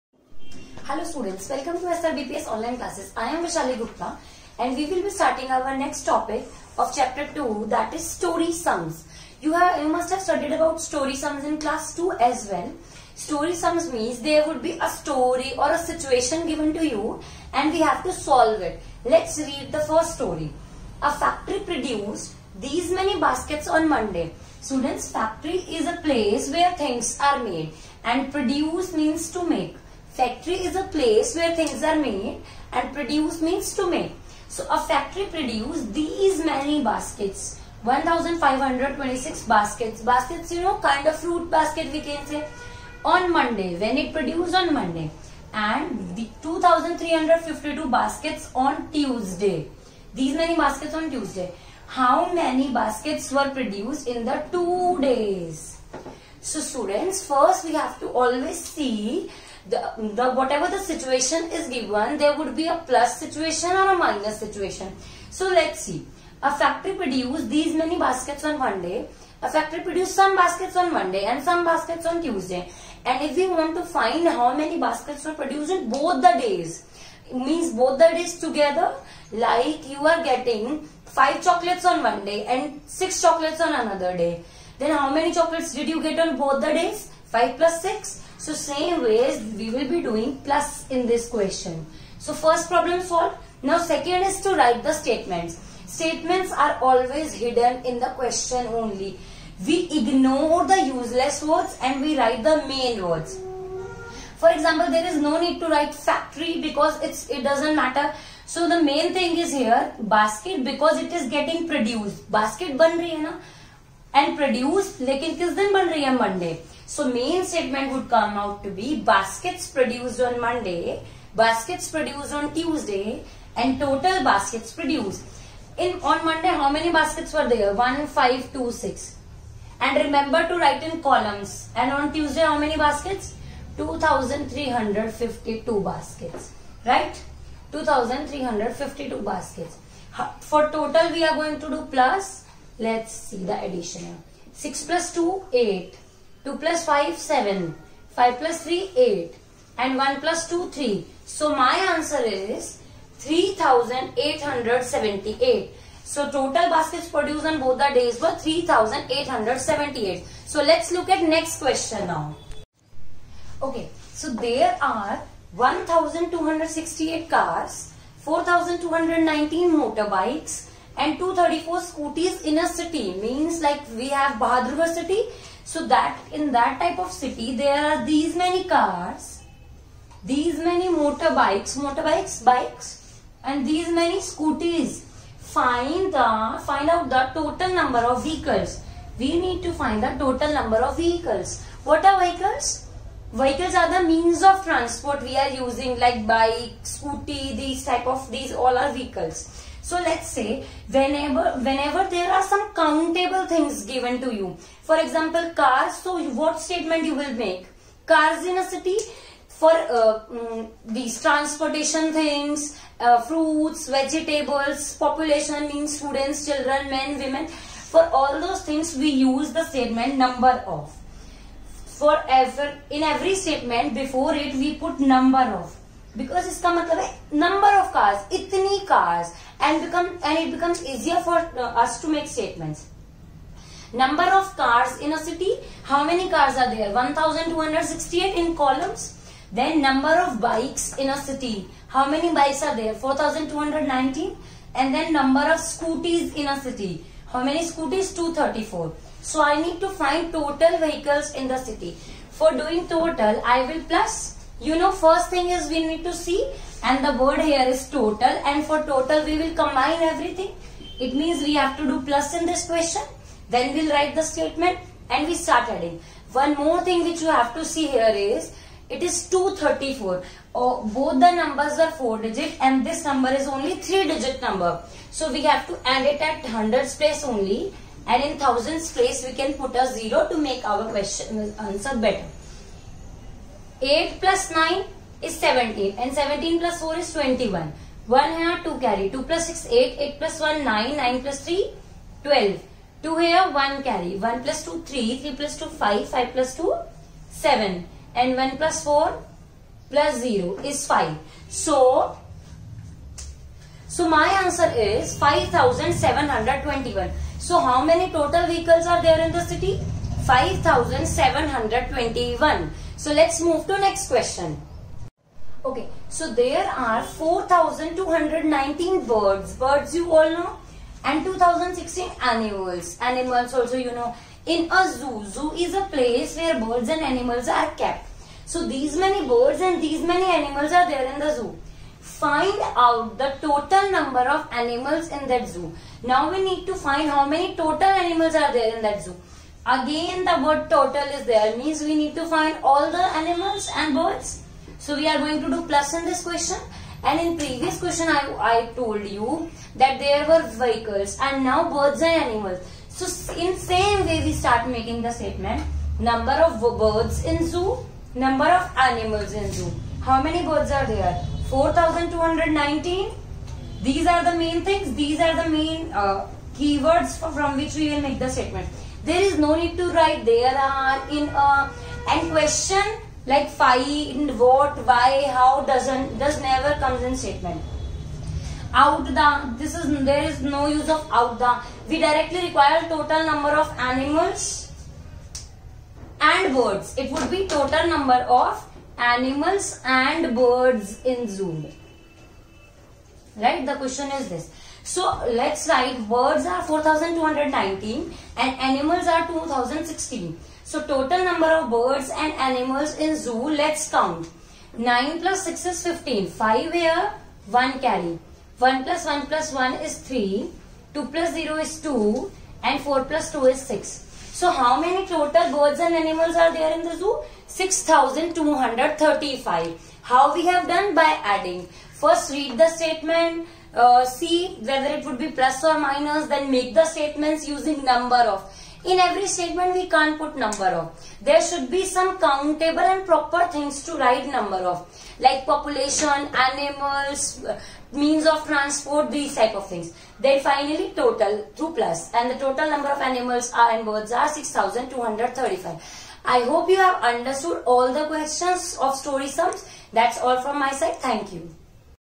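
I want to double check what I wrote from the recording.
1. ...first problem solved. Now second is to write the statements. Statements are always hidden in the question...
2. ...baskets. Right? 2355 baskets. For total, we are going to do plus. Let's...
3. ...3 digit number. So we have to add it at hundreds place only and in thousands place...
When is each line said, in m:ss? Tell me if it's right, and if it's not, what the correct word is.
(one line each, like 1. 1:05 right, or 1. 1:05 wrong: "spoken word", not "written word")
1. 1:32 right
2. 2:15 wrong: "2352", not "2355"
3. 4:33 right.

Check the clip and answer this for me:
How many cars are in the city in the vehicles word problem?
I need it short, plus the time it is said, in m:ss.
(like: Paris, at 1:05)
1268, at 3:56.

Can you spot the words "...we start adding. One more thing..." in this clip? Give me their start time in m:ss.
4:25.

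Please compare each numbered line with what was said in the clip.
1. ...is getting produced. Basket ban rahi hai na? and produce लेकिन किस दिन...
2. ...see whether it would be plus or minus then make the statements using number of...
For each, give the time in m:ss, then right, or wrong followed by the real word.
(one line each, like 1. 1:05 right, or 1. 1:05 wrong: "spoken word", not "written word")
1. 1:51 right
2. 7:04 right.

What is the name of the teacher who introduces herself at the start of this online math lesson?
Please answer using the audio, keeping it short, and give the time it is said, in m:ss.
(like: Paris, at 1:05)
Vishali Gupta, at 0:03.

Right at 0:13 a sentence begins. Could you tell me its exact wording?
Story sums means there would be a story or a situation given to you and we have to solve it.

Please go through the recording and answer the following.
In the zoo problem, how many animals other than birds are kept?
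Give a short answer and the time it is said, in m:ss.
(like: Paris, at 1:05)
2016, at 5:21.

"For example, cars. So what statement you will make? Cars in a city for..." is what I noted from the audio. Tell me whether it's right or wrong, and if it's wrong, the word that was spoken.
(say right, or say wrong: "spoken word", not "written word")
right.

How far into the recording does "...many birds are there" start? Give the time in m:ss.
6:00.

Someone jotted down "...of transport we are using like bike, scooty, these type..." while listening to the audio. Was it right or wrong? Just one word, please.
right.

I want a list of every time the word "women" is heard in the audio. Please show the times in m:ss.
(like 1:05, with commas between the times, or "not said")
3:37.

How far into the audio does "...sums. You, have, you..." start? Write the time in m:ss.
0:08.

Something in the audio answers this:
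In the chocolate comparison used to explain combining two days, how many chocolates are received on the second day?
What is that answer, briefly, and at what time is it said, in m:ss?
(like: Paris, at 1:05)
6, at 1:22.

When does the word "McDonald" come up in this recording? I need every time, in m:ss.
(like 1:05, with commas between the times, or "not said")
not said.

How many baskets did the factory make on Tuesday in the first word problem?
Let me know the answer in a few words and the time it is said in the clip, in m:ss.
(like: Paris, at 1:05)
2352, at 0:46.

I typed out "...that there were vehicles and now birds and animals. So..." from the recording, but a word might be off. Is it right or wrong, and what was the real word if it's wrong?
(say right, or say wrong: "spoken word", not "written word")
right.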